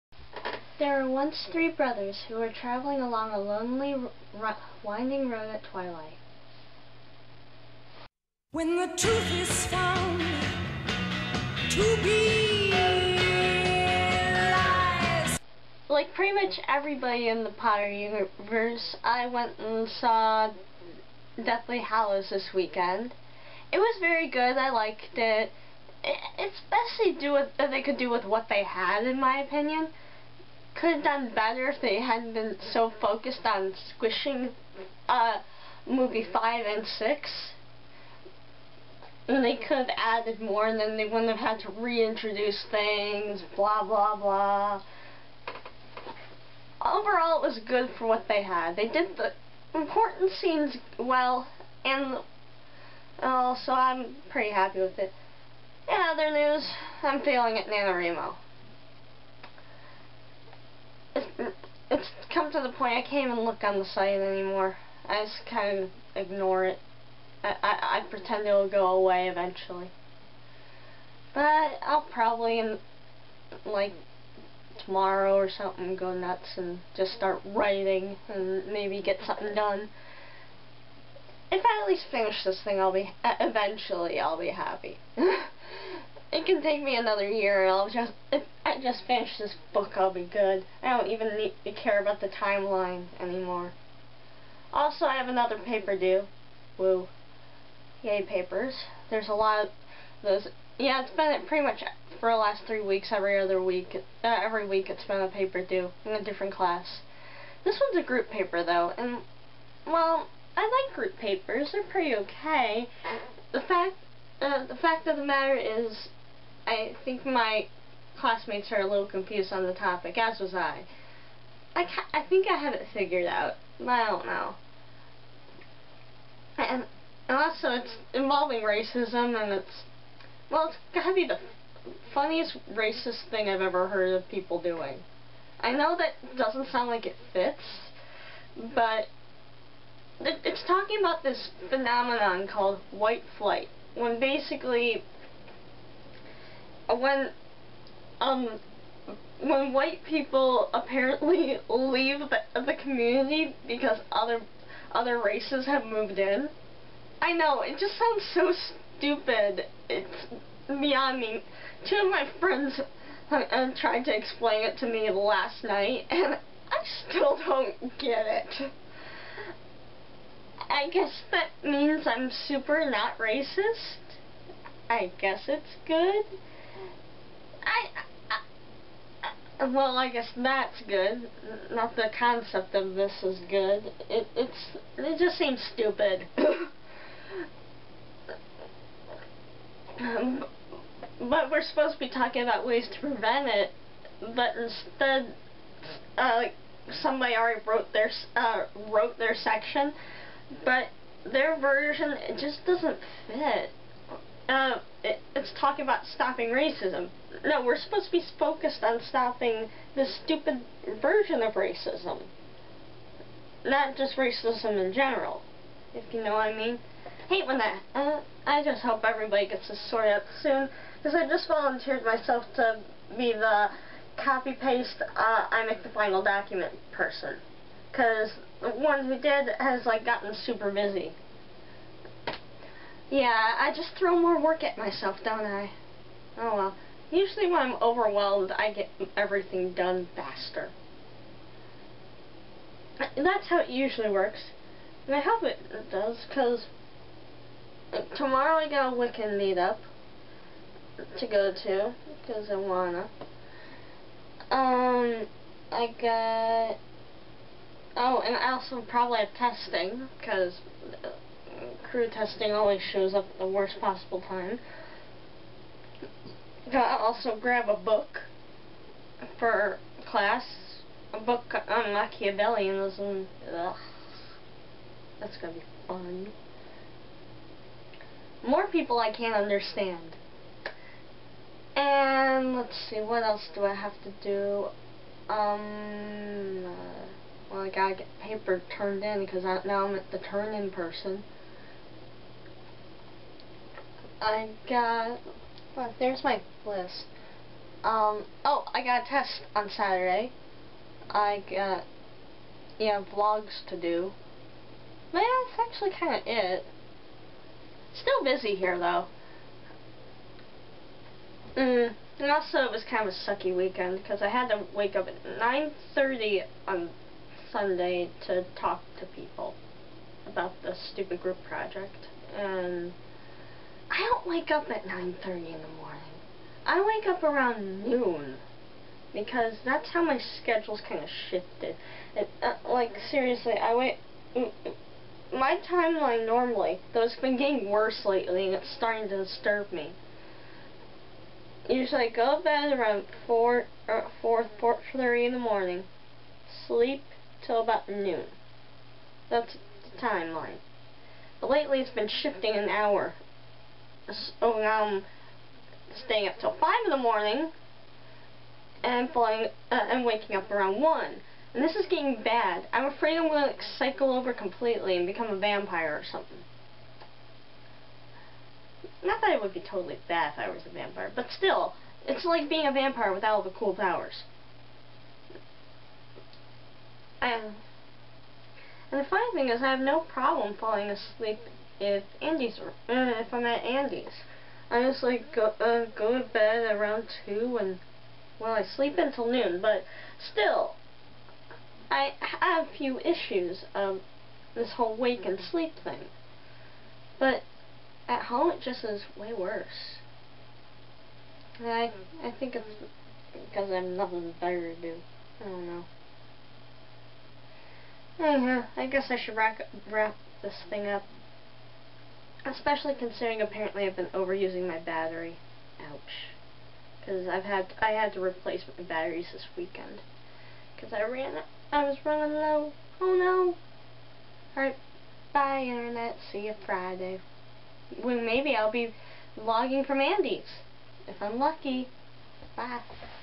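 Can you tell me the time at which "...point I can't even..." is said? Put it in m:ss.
1:02.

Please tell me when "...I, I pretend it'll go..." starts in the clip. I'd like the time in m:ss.
1:07.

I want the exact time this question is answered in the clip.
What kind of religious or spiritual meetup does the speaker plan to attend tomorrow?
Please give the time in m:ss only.
4:08.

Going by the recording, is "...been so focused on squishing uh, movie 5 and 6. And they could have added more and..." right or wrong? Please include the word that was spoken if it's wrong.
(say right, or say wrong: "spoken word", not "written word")
right.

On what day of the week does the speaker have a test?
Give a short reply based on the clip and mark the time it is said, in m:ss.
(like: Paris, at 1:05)
Saturday, at 4:59.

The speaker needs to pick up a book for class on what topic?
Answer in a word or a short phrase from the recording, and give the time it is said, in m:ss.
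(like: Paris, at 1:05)
Machiavellianism, at 4:31.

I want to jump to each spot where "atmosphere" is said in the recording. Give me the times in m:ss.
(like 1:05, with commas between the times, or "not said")
not said.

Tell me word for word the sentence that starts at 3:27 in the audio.
No, we're supposed to be focused on stopping the stupid version of racism.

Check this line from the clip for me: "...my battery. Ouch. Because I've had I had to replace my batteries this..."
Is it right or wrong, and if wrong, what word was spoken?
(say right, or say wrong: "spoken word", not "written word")
right.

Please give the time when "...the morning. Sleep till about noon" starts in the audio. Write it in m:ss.
5:45.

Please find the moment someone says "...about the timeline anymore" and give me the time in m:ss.
1:31.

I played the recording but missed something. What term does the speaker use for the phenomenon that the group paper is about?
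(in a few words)
white flight.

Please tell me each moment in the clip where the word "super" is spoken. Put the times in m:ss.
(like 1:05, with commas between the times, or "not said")
2:52, 3:50.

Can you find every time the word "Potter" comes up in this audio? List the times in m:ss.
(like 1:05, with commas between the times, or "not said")
0:17.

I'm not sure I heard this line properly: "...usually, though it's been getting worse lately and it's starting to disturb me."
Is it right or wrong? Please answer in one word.
wrong.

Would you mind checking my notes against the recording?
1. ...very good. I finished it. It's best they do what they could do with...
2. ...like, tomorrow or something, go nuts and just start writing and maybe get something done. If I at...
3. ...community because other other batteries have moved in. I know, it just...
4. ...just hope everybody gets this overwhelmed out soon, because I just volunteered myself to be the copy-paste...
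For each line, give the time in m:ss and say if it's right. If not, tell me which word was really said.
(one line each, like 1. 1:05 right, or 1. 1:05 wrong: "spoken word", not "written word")
1. 0:23 wrong: "liked", not "finished"
2. 1:13 right
3. 2:32 wrong: "races", not "batteries"
4. 3:38 wrong: "sorted", not "overwhelmed".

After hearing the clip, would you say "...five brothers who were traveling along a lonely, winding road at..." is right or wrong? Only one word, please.
wrong.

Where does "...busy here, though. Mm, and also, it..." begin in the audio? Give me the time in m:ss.
5:08.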